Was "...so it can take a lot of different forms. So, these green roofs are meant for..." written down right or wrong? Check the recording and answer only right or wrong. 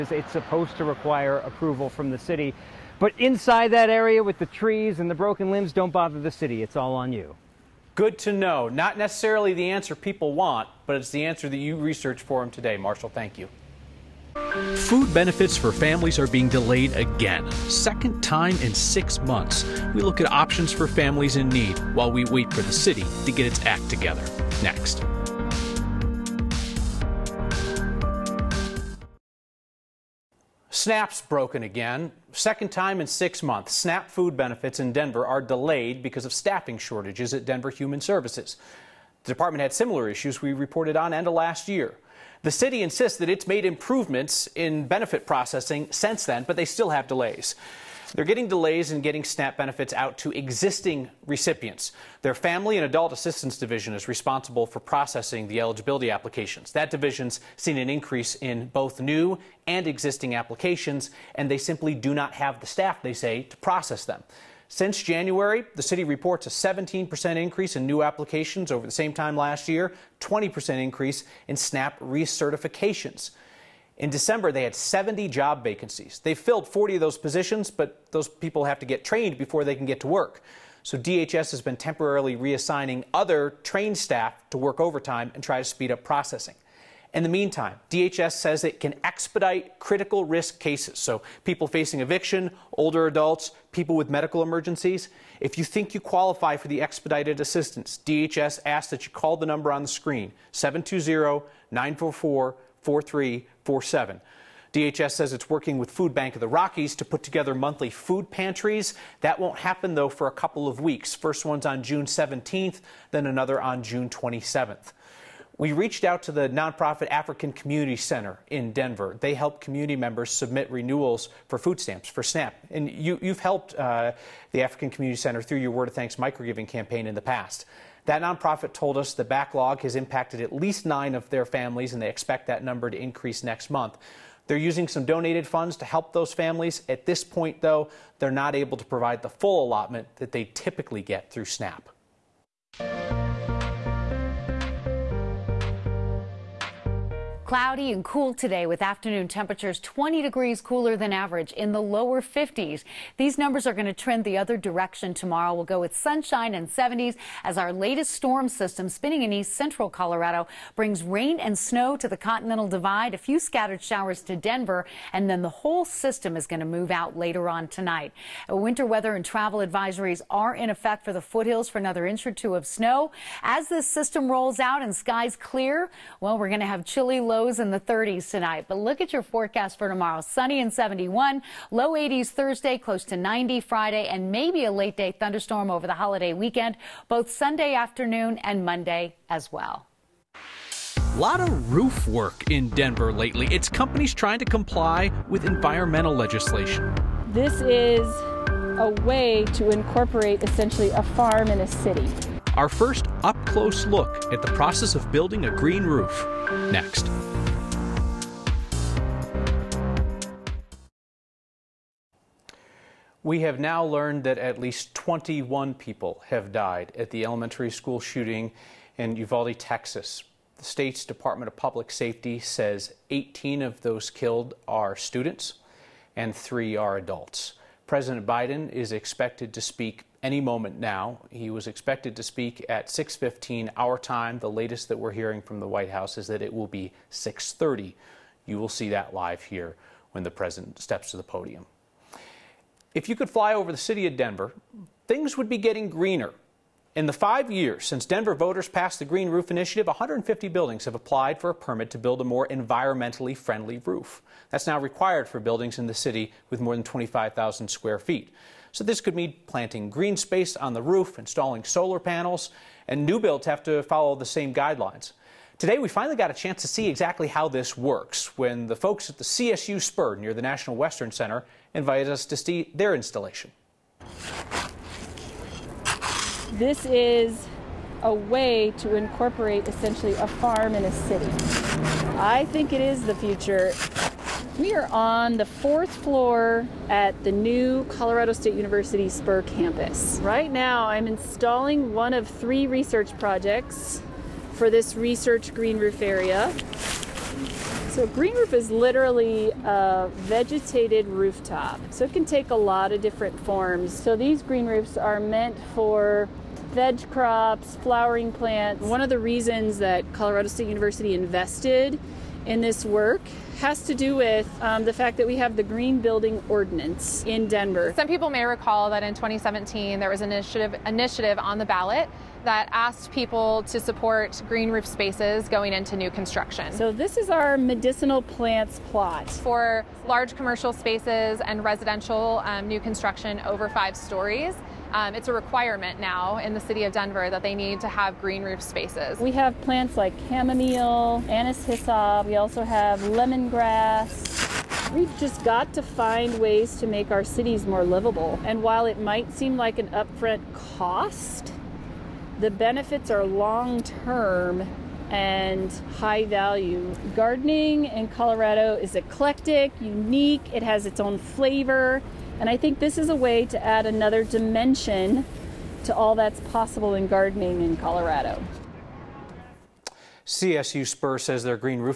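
right.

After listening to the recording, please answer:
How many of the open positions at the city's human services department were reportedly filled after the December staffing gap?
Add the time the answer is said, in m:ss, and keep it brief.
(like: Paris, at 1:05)
40, at 1:16.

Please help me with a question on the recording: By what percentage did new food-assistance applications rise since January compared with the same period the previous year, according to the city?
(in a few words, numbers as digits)
17%.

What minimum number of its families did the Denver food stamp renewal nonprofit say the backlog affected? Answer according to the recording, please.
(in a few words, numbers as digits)
9.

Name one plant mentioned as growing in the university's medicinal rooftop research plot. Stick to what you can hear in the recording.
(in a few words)
Chamomile.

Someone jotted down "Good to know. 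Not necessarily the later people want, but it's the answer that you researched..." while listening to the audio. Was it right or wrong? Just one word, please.
wrong.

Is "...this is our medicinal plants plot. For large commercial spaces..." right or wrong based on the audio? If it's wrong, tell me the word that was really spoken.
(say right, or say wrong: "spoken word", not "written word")
right.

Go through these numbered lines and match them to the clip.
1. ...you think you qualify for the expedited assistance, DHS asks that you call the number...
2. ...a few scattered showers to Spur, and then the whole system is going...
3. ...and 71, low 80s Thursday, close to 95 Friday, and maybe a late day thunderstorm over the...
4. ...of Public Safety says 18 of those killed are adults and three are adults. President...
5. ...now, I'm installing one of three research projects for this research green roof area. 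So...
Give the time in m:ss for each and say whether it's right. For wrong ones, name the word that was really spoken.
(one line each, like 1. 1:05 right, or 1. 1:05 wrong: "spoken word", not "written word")
1. 1:35 right
2. 2:43 wrong: "Denver", not "Spur"
3. 3:00 wrong: "90", not "95"
4. 3:41 wrong: "students", not "adults"
5. 4:50 right.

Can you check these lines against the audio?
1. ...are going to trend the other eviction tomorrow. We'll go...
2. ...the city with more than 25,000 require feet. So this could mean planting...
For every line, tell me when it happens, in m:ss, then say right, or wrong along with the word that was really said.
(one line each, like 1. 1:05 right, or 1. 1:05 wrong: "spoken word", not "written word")
1. 2:33 wrong: "direction", not "eviction"
2. 4:15 wrong: "square", not "require".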